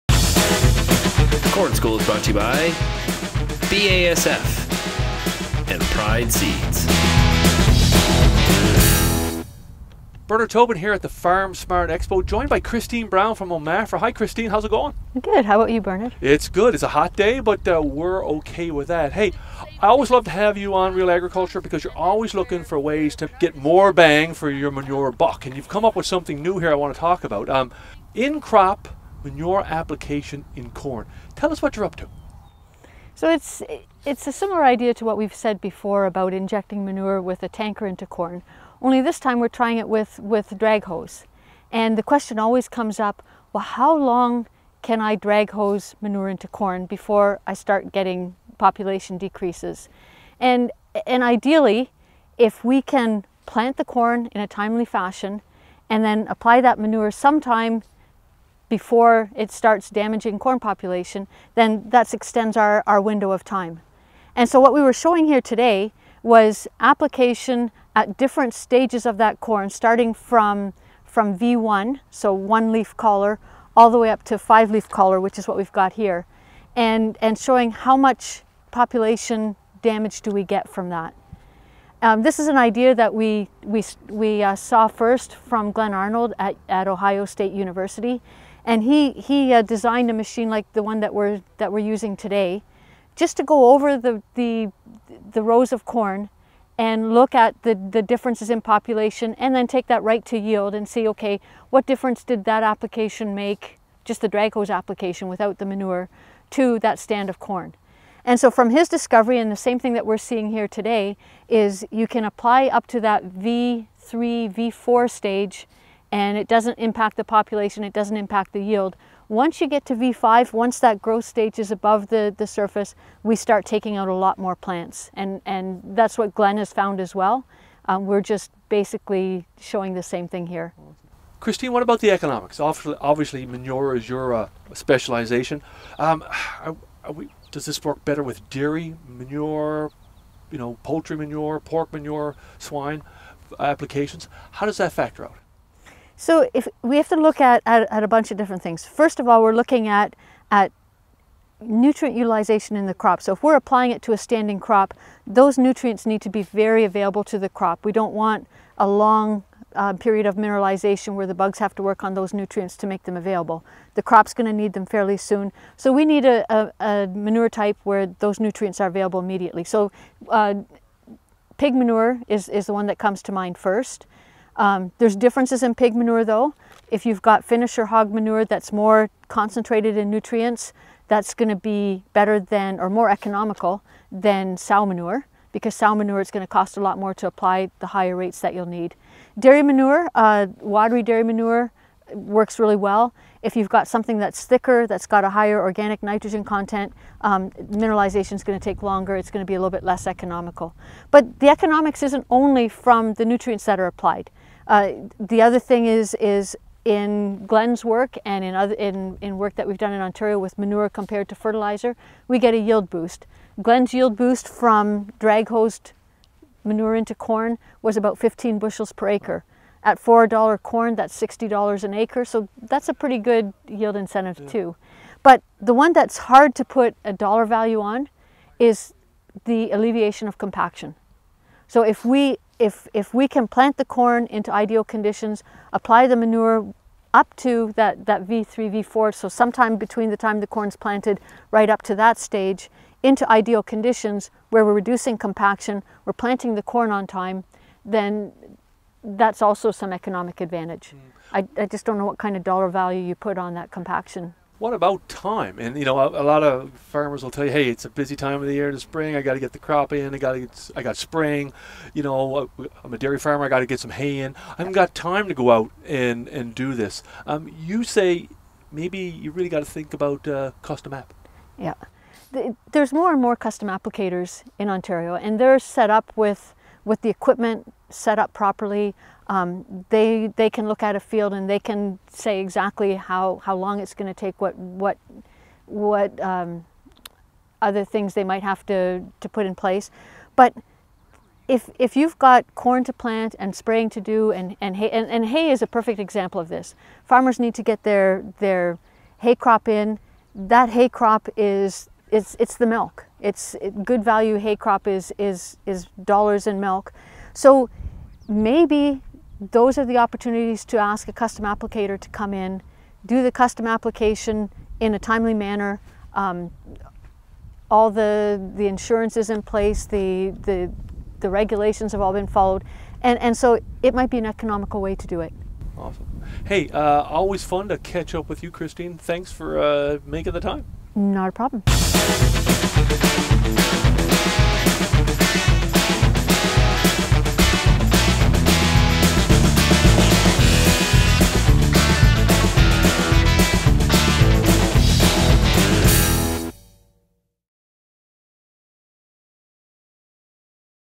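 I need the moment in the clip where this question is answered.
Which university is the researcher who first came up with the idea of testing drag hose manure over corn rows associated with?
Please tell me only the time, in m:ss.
1:26.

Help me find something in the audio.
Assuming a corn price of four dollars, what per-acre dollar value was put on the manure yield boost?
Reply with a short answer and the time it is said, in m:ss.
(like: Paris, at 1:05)
$60, at 3:41.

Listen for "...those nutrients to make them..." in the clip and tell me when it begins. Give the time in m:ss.
2:42.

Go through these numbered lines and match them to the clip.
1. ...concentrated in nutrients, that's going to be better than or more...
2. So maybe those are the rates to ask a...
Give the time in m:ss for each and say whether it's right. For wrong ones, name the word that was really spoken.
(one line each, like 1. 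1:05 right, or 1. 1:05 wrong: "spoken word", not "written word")
1. 2:59 right
2. 5:07 wrong: "opportunities", not "rates".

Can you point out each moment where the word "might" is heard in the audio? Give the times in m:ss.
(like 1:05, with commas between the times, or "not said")
4:48, 5:23.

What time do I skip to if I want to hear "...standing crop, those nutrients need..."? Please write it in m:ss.
2:34.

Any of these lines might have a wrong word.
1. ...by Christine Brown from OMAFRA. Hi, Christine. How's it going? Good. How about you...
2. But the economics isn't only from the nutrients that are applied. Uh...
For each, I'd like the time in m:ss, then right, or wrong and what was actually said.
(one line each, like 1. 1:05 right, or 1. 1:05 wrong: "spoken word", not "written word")
1. 0:12 right
2. 3:21 right.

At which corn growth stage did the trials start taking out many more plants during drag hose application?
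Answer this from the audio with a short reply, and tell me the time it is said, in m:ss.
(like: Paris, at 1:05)
V5, at 1:59.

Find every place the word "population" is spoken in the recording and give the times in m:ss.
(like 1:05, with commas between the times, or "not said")
0:48, 1:00, 1:18, 1:38, 1:57.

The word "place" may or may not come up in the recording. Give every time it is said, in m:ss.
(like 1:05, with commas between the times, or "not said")
4:49, 5:19.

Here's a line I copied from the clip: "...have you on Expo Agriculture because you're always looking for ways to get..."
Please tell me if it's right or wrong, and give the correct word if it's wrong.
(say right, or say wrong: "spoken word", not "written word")
wrong: "Real", not "Expo".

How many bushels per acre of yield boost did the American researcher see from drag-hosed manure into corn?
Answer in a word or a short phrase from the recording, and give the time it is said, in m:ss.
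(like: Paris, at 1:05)
15, at 3:38.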